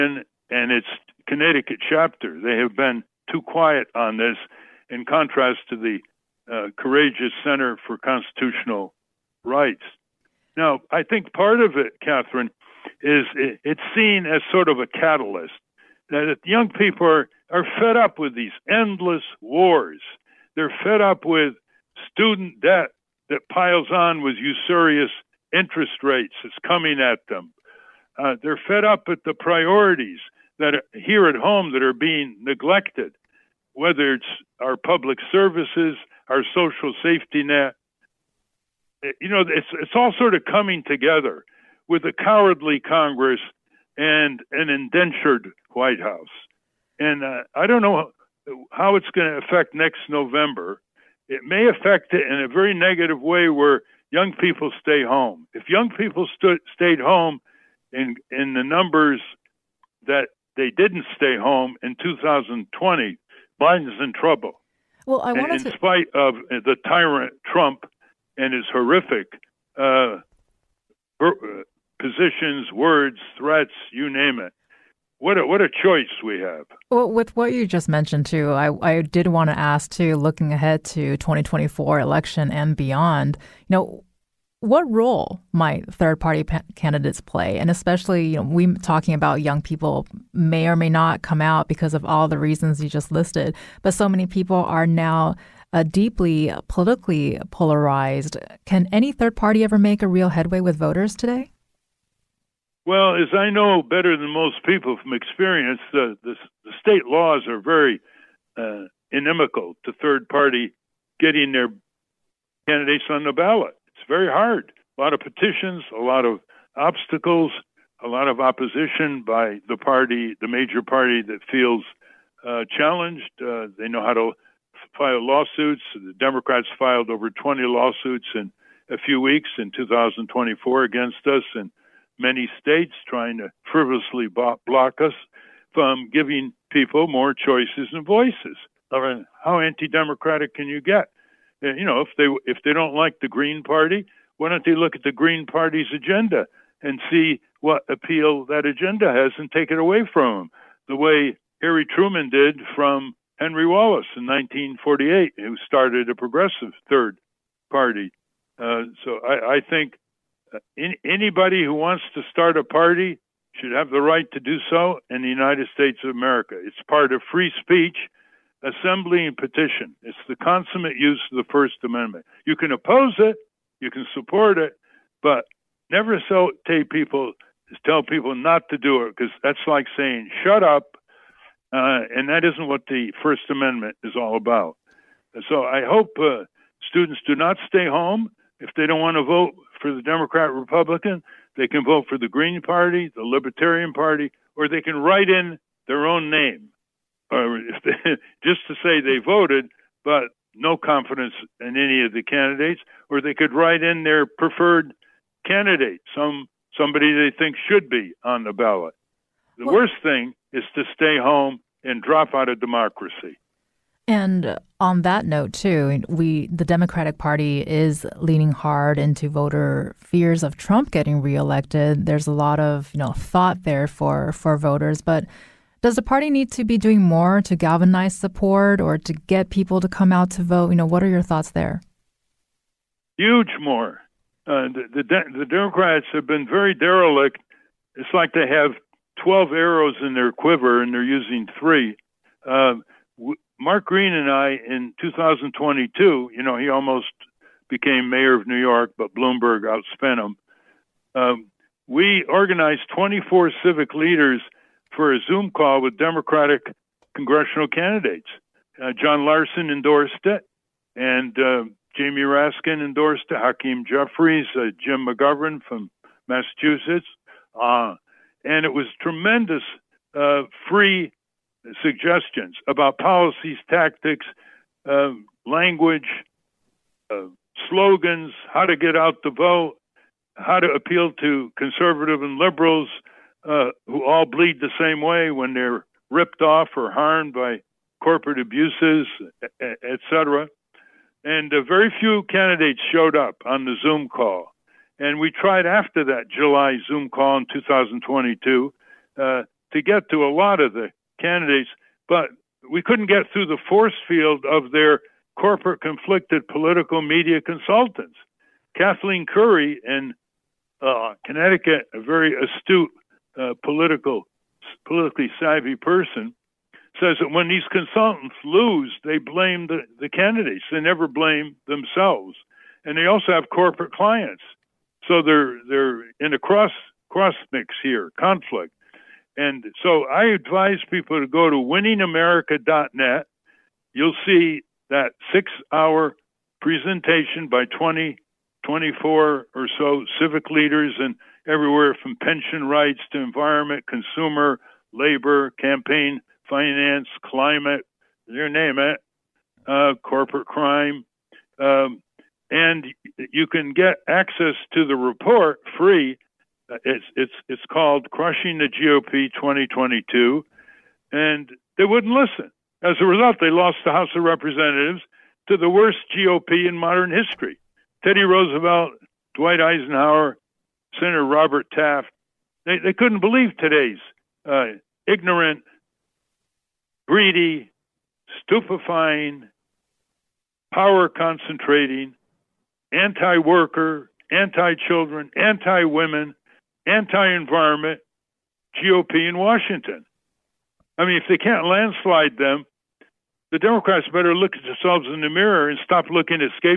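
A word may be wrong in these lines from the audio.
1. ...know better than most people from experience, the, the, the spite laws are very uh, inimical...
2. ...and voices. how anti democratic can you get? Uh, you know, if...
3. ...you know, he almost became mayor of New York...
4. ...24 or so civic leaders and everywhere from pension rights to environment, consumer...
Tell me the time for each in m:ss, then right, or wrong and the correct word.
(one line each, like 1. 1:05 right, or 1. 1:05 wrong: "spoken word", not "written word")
1. 1:43 wrong: "state", not "spite"
2. 2:17 right
3. 4:06 right
4. 5:38 right.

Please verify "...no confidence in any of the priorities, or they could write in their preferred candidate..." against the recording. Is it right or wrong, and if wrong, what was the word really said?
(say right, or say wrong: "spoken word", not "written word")
wrong: "candidates", not "priorities".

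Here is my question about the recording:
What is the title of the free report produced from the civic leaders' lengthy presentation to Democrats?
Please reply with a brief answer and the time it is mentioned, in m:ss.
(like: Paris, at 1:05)
Crushing the GOP 2022, at 5:58.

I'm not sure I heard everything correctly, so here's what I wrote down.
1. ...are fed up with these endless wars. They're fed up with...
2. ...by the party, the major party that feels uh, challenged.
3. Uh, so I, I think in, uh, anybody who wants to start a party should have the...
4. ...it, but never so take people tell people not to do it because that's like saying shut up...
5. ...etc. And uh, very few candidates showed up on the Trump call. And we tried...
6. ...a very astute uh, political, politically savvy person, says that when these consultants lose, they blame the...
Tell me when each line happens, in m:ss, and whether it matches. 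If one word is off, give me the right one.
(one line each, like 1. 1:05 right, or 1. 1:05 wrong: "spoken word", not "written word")
1. 0:17 right
2. 1:59 right
3. 2:38 right
4. 2:54 right
5. 4:49 wrong: "Zoom", not "Trump"
6. 5:11 right.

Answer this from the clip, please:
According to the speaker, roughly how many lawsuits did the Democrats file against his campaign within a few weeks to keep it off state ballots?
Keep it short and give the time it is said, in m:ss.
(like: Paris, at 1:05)
over 20, at 2:07.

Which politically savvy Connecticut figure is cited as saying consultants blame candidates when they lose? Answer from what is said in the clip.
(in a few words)
Kathleen Curry.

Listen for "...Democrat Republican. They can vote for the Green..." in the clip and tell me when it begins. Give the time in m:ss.
3:10.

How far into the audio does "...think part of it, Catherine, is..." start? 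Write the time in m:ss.
0:11.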